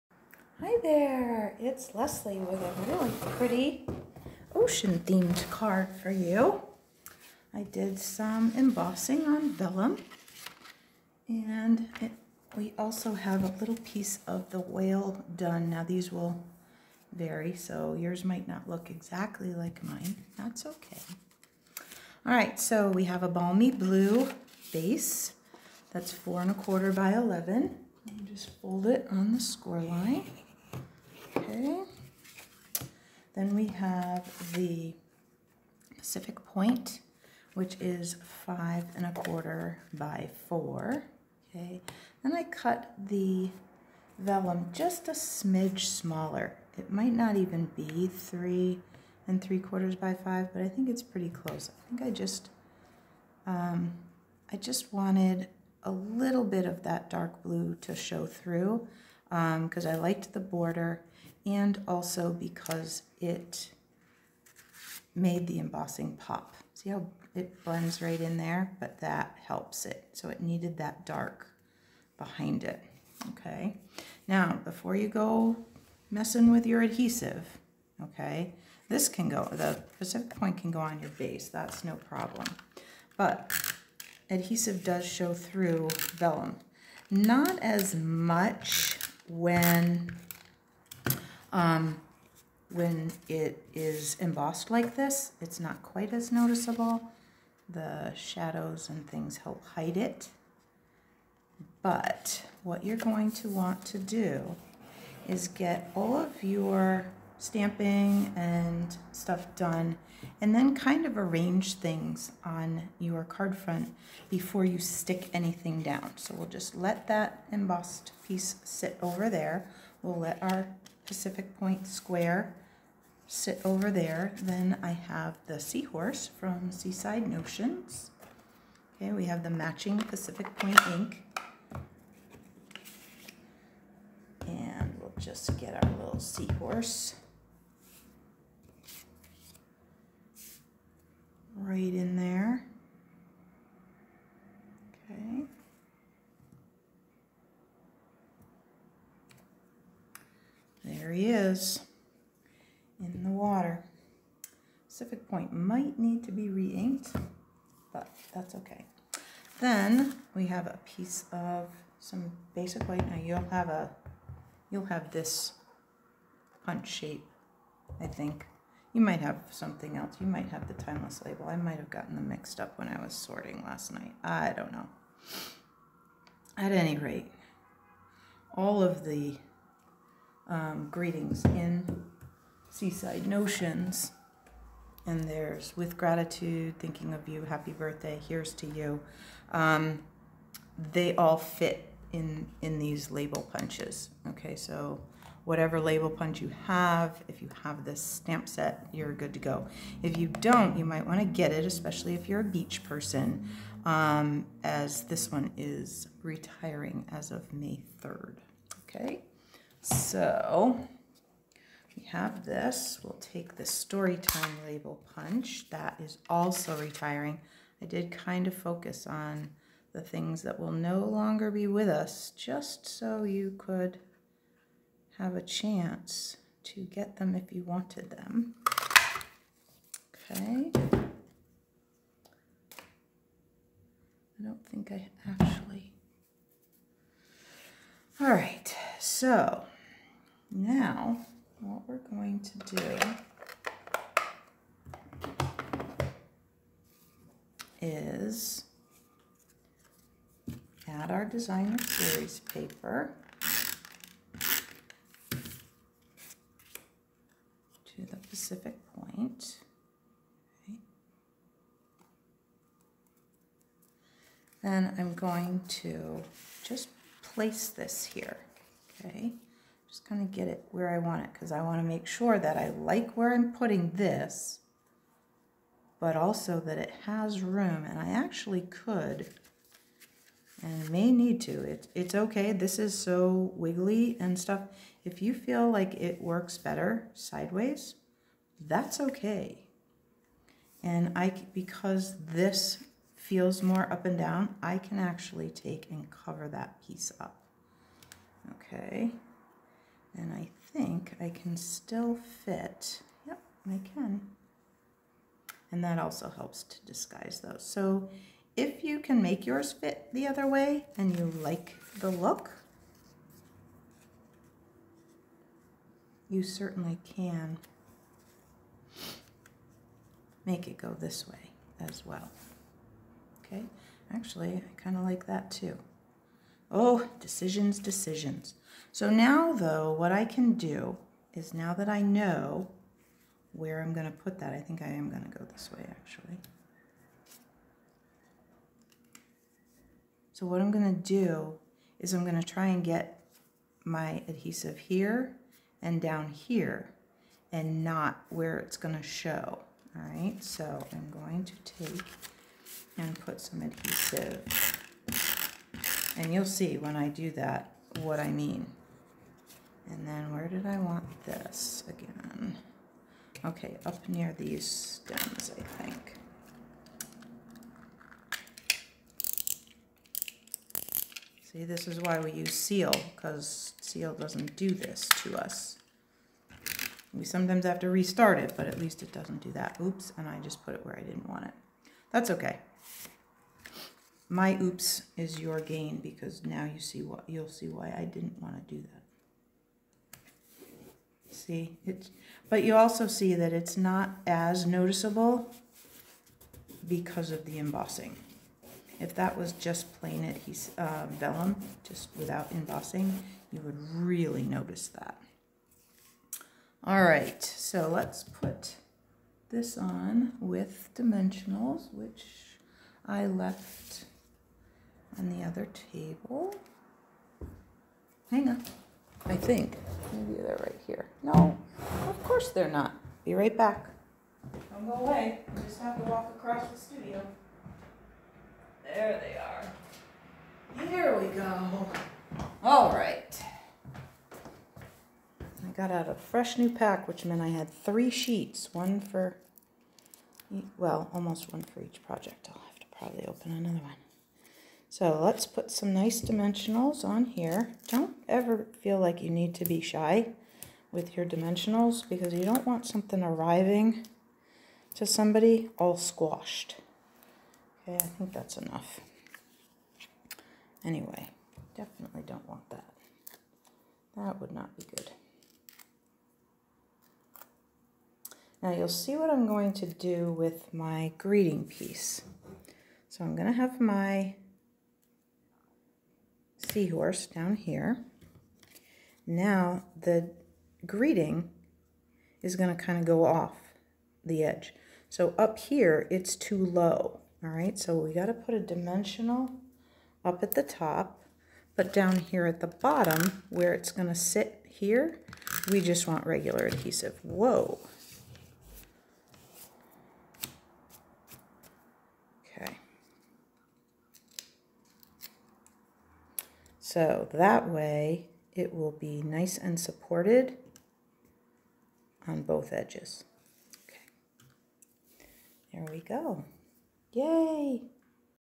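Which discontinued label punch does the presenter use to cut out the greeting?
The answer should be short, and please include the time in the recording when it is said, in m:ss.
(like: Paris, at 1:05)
Story Time label punch, at 3:33.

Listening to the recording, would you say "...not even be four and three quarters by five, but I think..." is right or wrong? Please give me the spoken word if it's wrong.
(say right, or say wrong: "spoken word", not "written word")
wrong: "three", not "four".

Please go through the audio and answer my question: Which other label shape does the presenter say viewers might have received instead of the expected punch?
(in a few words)
Timeless label.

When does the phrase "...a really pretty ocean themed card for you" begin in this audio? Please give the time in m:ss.
0:02.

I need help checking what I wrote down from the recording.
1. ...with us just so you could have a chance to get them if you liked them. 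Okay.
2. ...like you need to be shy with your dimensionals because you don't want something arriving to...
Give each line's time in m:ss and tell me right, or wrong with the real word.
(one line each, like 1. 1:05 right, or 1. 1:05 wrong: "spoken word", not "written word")
1. 3:41 wrong: "wanted", not "liked"
2. 7:28 right.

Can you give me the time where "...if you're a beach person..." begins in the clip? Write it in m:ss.
3:22.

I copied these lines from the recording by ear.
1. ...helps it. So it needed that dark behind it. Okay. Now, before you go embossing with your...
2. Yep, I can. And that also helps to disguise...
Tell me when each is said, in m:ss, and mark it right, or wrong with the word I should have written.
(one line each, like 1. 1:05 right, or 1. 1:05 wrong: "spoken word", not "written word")
1. 1:09 wrong: "messing", not "embossing"
2. 5:03 right.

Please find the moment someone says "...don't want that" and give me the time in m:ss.
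7:42.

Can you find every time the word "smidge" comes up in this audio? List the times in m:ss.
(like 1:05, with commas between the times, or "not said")
0:45.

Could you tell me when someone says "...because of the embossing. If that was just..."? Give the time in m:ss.
6:36.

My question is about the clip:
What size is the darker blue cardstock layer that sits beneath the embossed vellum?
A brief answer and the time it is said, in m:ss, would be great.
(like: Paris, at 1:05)
5 1/4 by 4, at 0:38.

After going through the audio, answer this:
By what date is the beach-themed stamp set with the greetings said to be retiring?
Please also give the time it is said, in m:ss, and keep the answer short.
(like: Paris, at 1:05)
May 3rd, at 3:27.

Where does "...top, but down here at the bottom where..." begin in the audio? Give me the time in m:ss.
8:10.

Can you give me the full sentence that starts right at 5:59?
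And then where did I want this again?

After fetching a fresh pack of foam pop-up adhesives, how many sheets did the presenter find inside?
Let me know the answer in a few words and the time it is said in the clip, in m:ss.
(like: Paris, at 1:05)
3, at 7:17.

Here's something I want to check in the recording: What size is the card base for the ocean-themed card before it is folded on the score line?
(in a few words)
4 1/4 by 11.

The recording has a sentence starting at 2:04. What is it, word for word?
Then I have the seahorse from Seaside Notions.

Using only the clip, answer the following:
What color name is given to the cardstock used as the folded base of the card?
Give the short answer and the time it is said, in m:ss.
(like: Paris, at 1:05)
Balmy Blue, at 0:23.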